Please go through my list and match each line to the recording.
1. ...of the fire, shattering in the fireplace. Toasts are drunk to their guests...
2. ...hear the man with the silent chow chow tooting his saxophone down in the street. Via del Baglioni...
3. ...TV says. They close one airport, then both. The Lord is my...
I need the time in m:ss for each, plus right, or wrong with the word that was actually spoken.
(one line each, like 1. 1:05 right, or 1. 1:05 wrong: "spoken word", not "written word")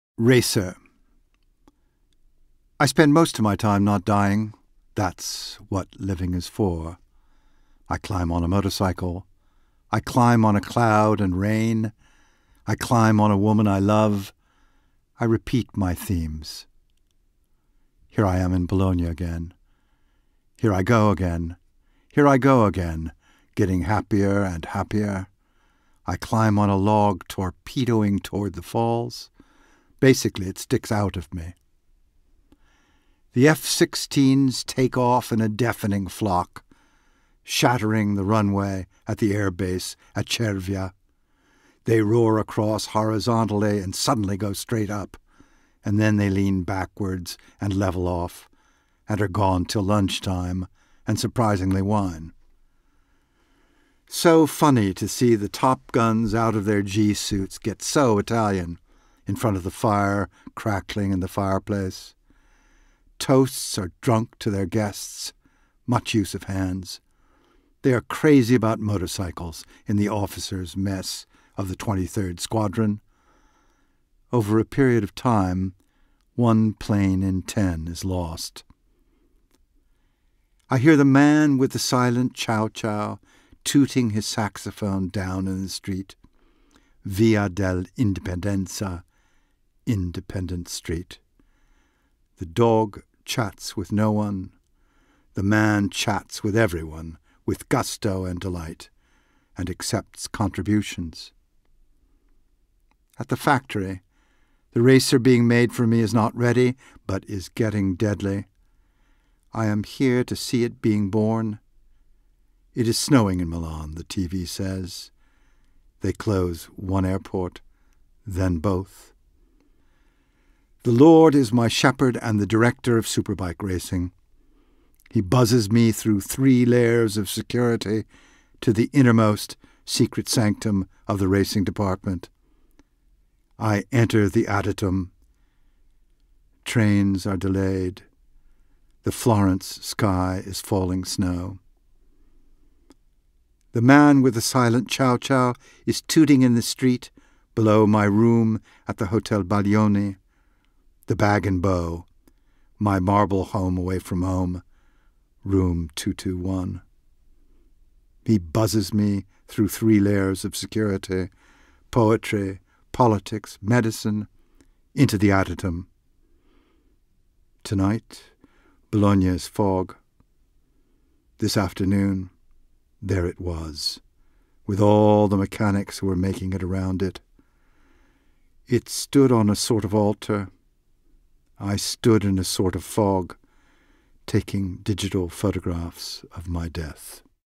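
1. 0:59 wrong: "crackling", not "shattering"
2. 1:20 wrong: "Independenza", not "Baglioni"
3. 1:54 right.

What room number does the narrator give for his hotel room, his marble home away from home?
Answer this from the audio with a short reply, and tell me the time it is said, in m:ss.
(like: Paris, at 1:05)
221, at 2:35.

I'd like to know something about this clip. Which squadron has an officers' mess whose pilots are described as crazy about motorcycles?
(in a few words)
23rd Squadron.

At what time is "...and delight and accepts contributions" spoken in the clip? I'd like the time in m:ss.
1:38.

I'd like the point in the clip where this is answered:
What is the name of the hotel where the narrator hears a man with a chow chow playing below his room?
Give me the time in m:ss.
2:29.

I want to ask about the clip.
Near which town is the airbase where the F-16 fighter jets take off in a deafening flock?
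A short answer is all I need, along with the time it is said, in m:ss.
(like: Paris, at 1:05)
Cervia, at 0:40.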